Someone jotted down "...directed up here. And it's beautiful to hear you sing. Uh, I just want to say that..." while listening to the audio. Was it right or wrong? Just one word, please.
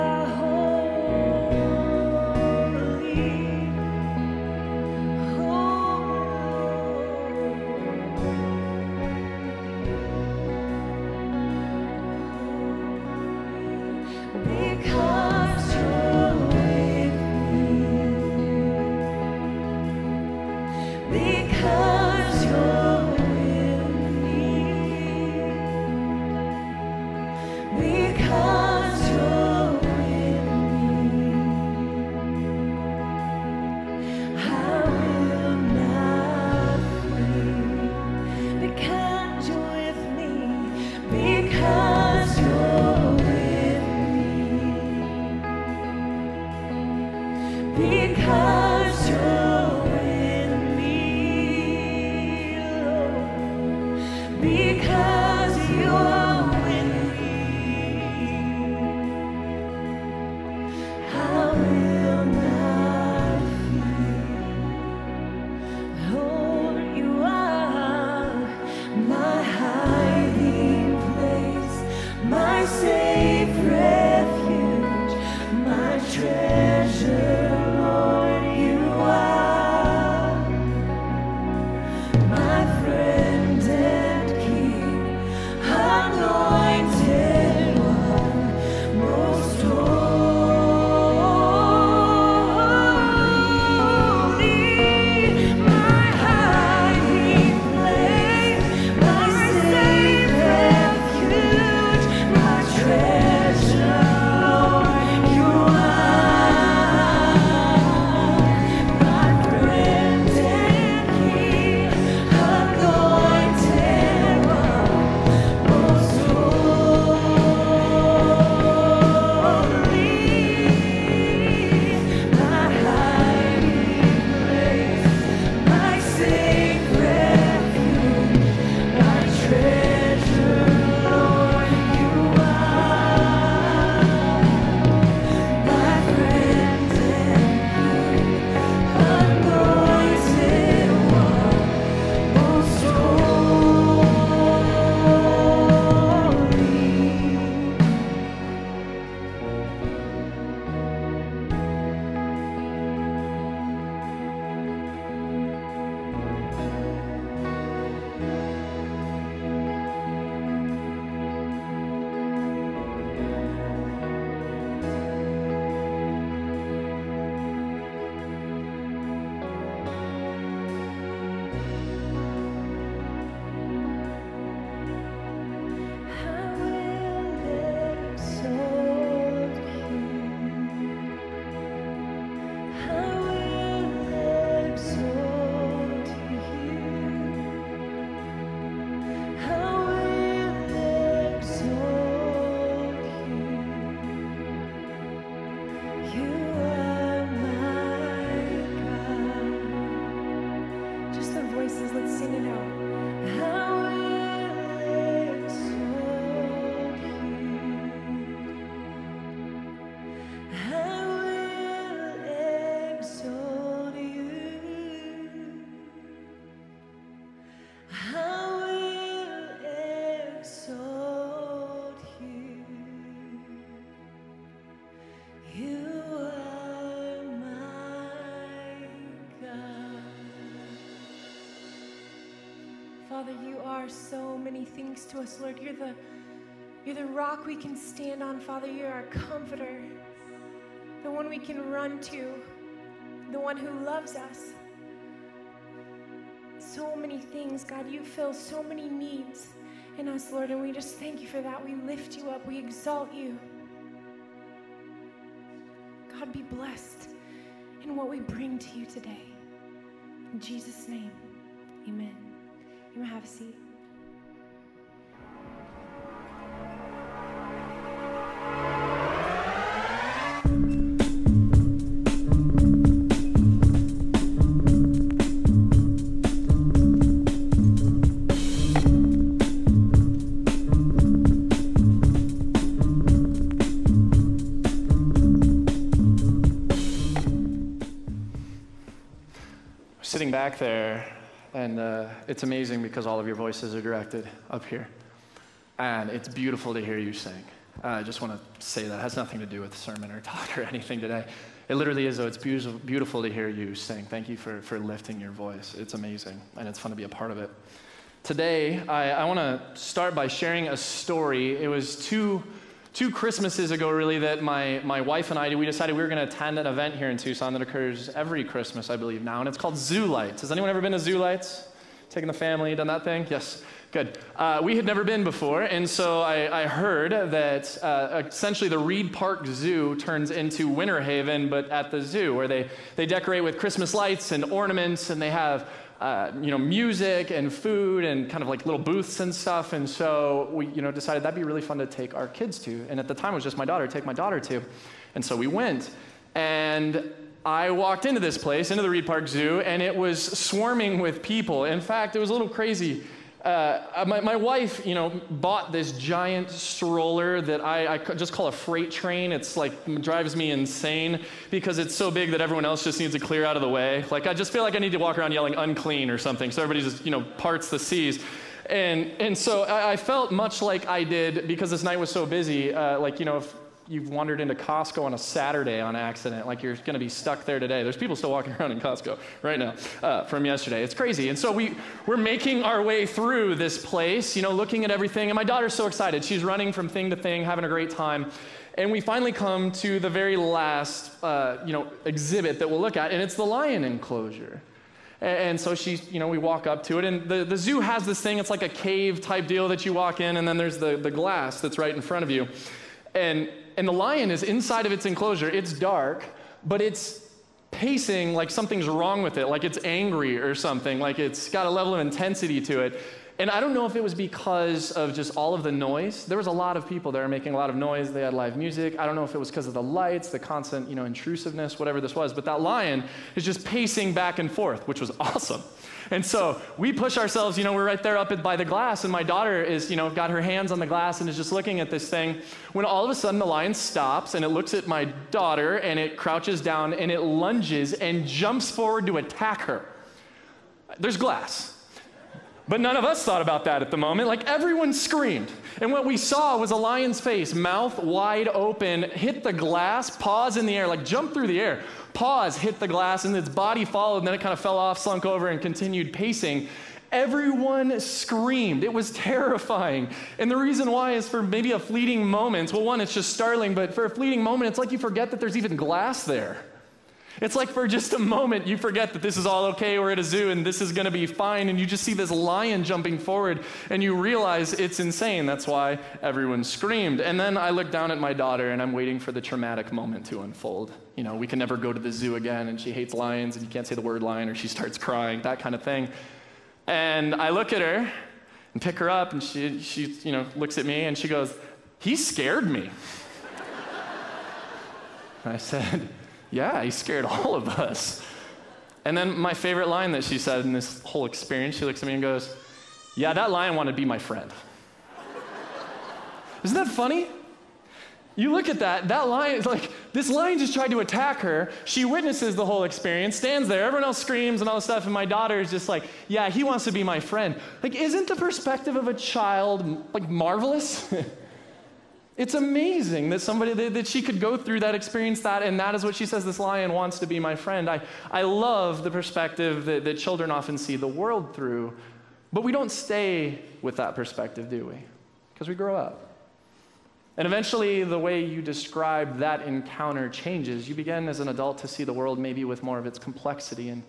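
right.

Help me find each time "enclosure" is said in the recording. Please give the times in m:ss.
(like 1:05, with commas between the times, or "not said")
6:33, 6:45.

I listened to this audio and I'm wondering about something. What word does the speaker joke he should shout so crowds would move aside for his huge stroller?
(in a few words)
unclean.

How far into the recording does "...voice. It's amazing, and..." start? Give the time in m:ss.
5:05.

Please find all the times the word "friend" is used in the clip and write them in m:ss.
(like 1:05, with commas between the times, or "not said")
8:24, 8:37, 8:47.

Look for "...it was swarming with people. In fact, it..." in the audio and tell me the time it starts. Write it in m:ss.
5:49.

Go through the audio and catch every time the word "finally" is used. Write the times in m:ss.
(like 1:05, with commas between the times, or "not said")
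6:29.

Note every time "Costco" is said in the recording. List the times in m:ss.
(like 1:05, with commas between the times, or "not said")
6:14, 6:18.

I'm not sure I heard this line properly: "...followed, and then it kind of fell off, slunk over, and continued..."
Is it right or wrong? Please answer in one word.
right.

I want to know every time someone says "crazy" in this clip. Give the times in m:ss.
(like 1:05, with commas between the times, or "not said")
5:52, 6:20.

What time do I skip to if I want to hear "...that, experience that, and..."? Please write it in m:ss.
8:44.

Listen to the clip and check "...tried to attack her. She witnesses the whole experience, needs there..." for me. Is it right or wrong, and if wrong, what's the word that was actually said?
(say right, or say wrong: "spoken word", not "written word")
wrong: "stands", not "needs".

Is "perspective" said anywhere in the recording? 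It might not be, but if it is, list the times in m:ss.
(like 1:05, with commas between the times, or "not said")
8:38, 8:49, 8:54.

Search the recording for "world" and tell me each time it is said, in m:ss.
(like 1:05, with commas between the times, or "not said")
8:51, 9:02.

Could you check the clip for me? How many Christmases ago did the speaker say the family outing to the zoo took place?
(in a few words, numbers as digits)
2.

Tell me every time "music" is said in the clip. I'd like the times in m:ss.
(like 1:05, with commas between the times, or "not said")
5:36, 6:58.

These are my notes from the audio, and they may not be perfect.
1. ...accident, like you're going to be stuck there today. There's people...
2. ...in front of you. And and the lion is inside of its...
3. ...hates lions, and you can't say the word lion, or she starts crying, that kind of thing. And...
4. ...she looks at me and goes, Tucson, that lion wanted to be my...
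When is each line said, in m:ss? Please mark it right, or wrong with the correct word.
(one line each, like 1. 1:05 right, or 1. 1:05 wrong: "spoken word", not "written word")
1. 6:15 right
2. 6:41 right
3. 8:02 right
4. 8:21 wrong: "Yeah", not "Tucson".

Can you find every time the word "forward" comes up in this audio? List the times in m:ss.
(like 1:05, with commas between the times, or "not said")
7:18, 7:53.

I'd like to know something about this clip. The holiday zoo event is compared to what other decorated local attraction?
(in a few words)
Winterhaven.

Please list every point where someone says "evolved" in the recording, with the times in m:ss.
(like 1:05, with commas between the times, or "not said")
not said.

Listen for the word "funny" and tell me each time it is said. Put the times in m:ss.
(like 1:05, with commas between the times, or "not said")
8:26.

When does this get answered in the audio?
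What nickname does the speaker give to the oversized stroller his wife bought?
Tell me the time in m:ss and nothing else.
5:58.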